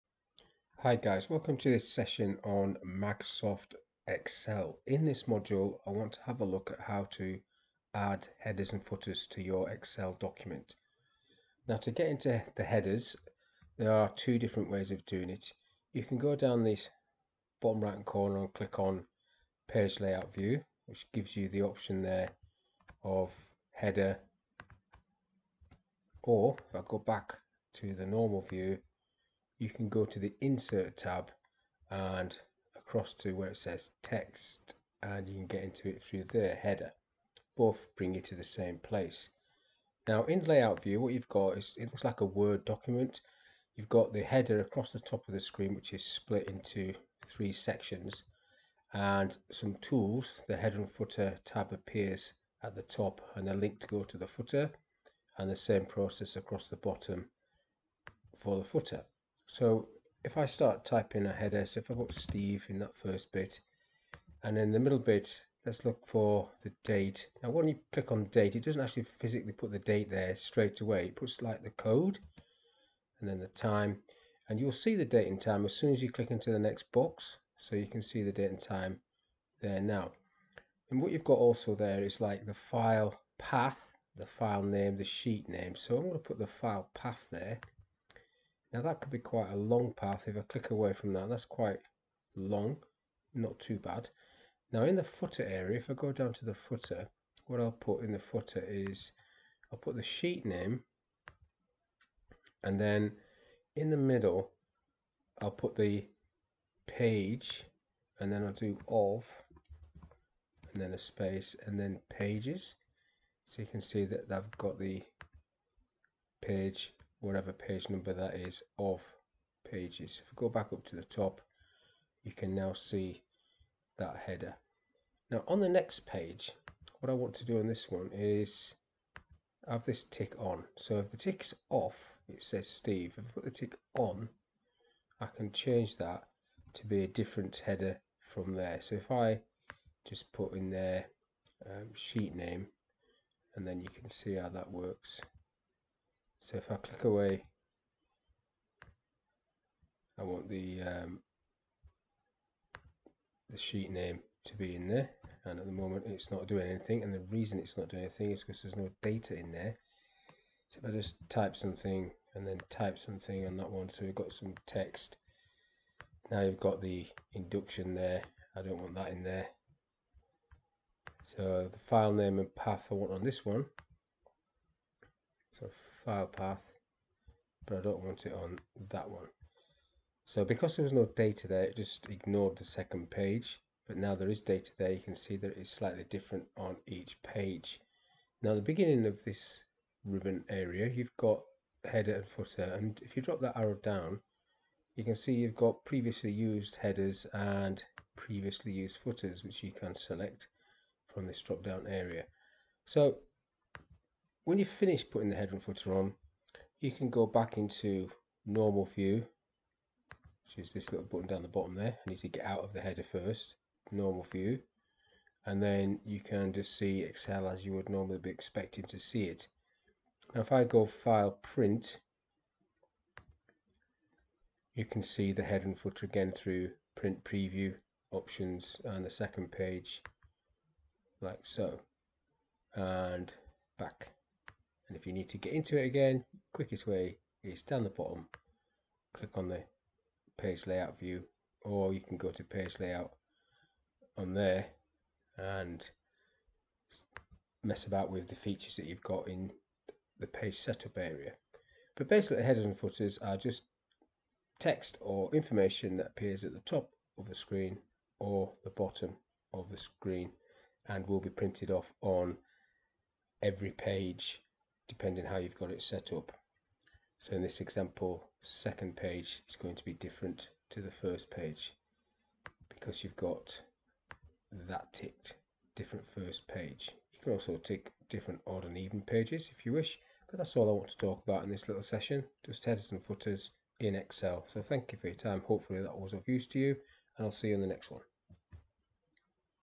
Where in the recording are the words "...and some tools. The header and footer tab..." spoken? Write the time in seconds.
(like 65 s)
48 s.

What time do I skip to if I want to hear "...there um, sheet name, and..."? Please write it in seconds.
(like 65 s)
140 s.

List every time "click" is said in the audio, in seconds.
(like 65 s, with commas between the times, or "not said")
18 s, 67 s, 76 s, 90 s, 146 s, 239 s.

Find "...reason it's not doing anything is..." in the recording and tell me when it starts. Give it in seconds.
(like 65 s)
157 s.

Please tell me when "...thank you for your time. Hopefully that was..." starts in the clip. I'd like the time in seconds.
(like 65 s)
284 s.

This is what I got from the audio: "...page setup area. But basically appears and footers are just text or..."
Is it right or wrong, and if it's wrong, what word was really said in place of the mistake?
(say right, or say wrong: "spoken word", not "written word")
wrong: "headers", not "appears".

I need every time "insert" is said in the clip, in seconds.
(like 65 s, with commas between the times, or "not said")
30 s.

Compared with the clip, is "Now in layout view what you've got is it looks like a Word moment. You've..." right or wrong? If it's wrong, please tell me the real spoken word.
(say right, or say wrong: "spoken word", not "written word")
wrong: "document", not "moment".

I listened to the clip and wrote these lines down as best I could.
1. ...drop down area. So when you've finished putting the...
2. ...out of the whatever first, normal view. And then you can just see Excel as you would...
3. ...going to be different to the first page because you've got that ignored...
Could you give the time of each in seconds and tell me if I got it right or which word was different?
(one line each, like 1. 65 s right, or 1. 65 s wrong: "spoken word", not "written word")
1. 201 s right
2. 212 s wrong: "header", not "whatever"
3. 269 s wrong: "ticked", not "ignored".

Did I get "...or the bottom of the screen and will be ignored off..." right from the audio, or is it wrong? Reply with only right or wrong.
wrong.